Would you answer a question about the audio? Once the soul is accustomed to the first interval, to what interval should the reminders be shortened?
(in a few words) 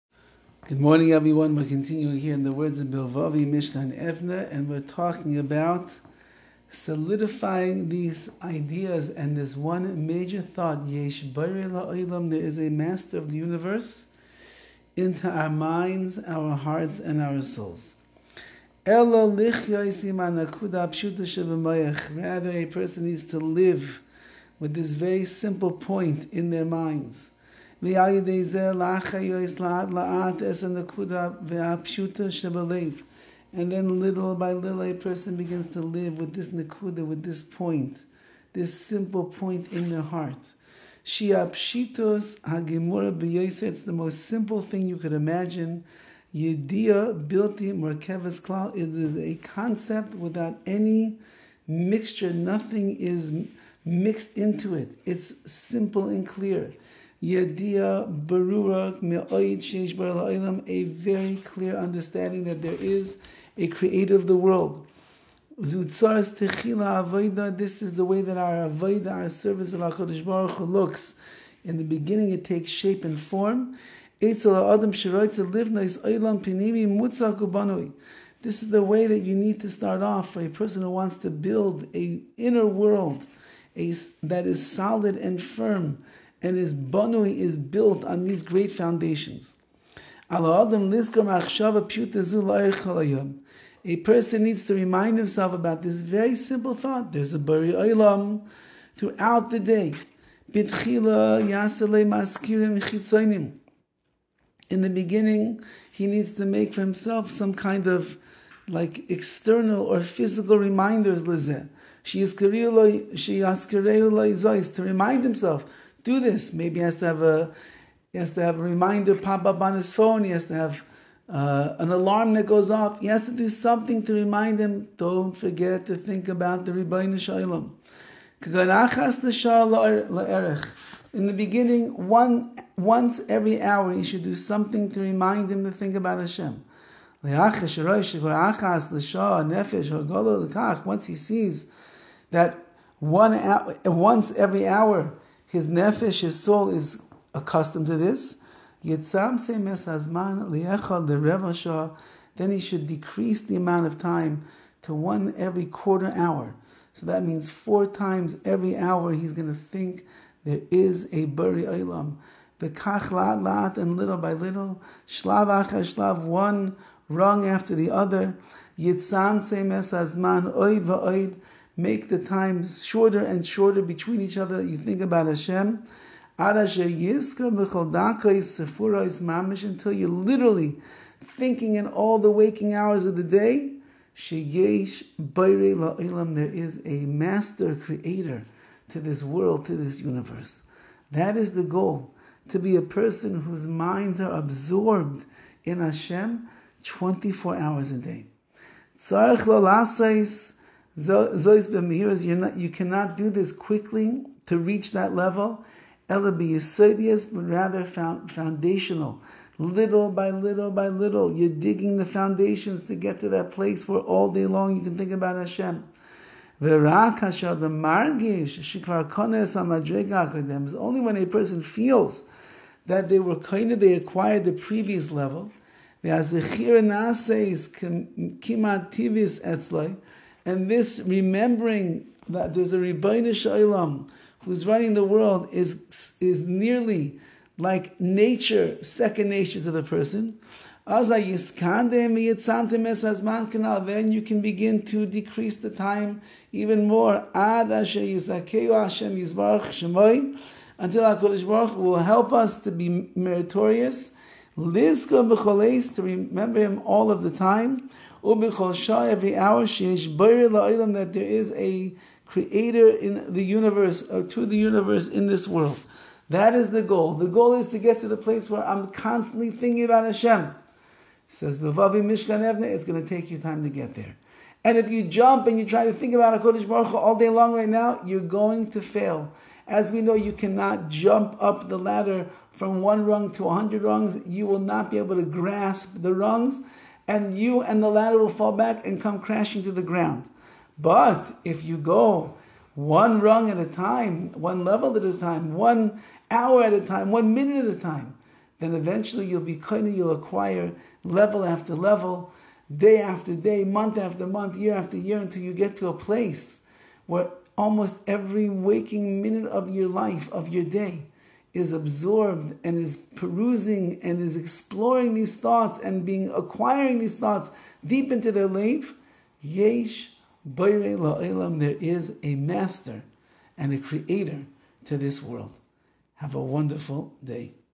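Every quarter hour.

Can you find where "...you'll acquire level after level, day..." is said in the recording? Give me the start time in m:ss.
4:59.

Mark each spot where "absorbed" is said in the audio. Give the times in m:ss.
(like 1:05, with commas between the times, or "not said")
3:14, 5:11.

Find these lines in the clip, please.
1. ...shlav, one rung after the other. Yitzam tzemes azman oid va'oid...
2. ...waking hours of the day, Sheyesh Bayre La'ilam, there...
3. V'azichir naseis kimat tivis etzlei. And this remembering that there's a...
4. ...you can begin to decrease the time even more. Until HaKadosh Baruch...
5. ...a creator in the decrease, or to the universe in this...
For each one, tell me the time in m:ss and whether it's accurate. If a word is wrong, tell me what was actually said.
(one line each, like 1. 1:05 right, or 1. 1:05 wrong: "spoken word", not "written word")
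1. 2:45 right
2. 3:02 right
3. 3:46 right
4. 4:04 right
5. 4:21 wrong: "universe", not "decrease".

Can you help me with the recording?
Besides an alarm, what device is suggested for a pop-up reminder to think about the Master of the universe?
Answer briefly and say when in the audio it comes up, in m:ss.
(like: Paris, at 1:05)
Phone, at 1:59.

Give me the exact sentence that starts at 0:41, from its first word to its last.
hagimura it's the most simple thing you could imagine.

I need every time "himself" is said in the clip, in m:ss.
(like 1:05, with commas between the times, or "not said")
1:35, 1:46, 1:55.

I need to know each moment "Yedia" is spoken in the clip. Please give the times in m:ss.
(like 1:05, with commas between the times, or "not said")
0:46, 0:57.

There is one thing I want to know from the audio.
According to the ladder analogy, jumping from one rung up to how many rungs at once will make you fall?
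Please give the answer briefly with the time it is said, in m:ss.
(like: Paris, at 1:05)
100, at 4:43.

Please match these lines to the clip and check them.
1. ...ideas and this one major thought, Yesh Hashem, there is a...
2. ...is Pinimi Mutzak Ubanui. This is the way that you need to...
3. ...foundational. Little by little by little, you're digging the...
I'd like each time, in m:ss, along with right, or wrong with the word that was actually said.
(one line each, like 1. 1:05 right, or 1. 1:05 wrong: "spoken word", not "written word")
1. 0:08 wrong: "Olam", not "Hashem"
2. 1:15 right
3. 3:27 right.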